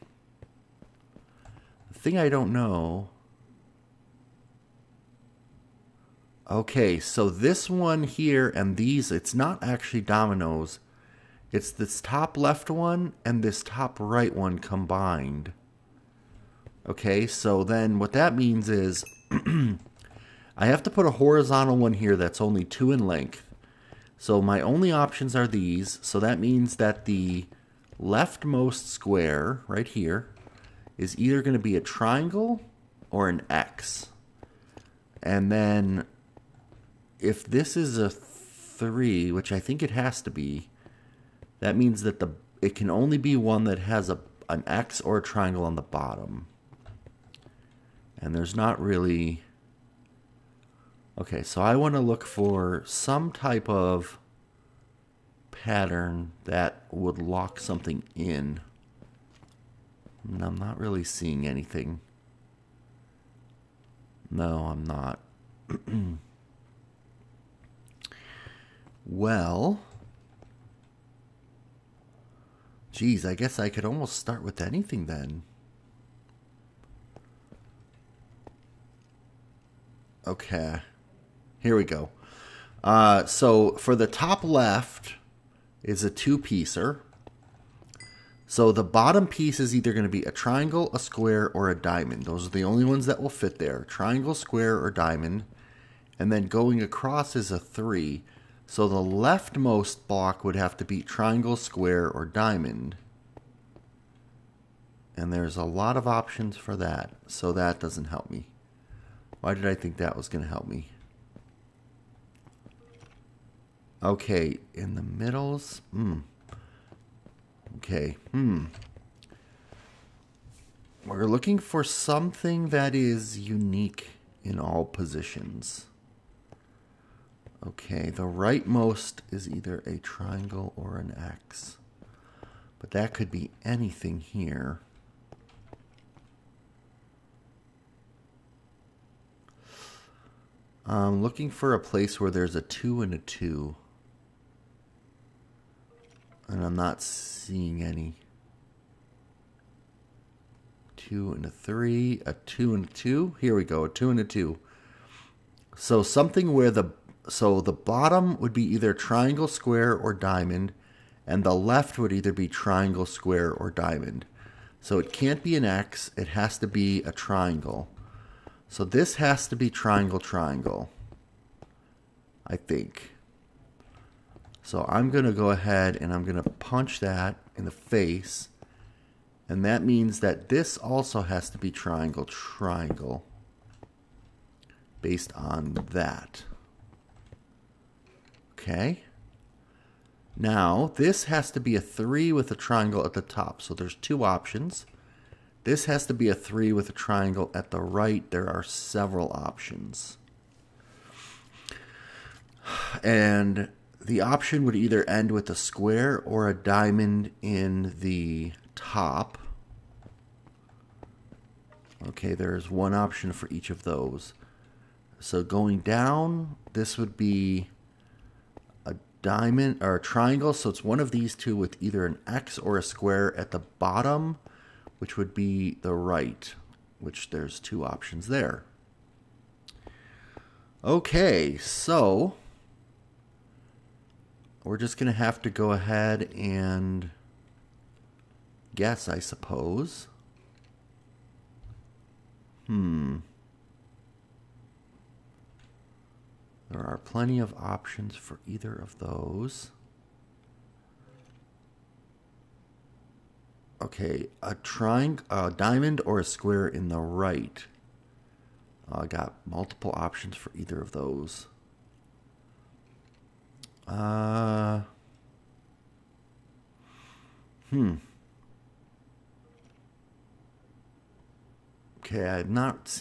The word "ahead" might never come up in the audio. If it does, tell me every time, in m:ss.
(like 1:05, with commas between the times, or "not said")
2:55, 3:55.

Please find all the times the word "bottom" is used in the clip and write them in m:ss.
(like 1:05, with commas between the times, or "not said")
0:45, 1:28, 2:37, 3:43.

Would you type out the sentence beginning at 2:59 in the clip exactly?
And that means that this also has to be triangle, triangle based on that.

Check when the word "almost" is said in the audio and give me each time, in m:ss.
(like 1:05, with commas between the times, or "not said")
1:13.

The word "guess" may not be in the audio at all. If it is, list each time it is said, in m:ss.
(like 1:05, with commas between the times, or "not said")
1:13, 3:58.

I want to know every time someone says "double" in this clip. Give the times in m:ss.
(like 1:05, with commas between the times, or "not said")
not said.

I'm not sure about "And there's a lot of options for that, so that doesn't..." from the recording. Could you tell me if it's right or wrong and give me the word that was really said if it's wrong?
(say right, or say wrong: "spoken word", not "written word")
right.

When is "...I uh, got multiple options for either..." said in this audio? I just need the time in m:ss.
4:19.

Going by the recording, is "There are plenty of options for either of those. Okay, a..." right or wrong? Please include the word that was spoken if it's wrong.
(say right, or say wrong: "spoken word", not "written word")
right.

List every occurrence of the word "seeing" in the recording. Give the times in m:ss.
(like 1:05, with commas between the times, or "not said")
1:01, 2:27.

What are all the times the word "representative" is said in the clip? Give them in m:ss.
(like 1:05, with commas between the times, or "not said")
not said.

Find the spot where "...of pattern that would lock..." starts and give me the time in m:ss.
0:53.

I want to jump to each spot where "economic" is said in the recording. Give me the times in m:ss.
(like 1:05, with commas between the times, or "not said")
not said.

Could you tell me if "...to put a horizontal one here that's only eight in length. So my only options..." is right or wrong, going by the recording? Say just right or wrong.
wrong.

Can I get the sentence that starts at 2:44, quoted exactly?
So it can't be an X, it has to be a triangle.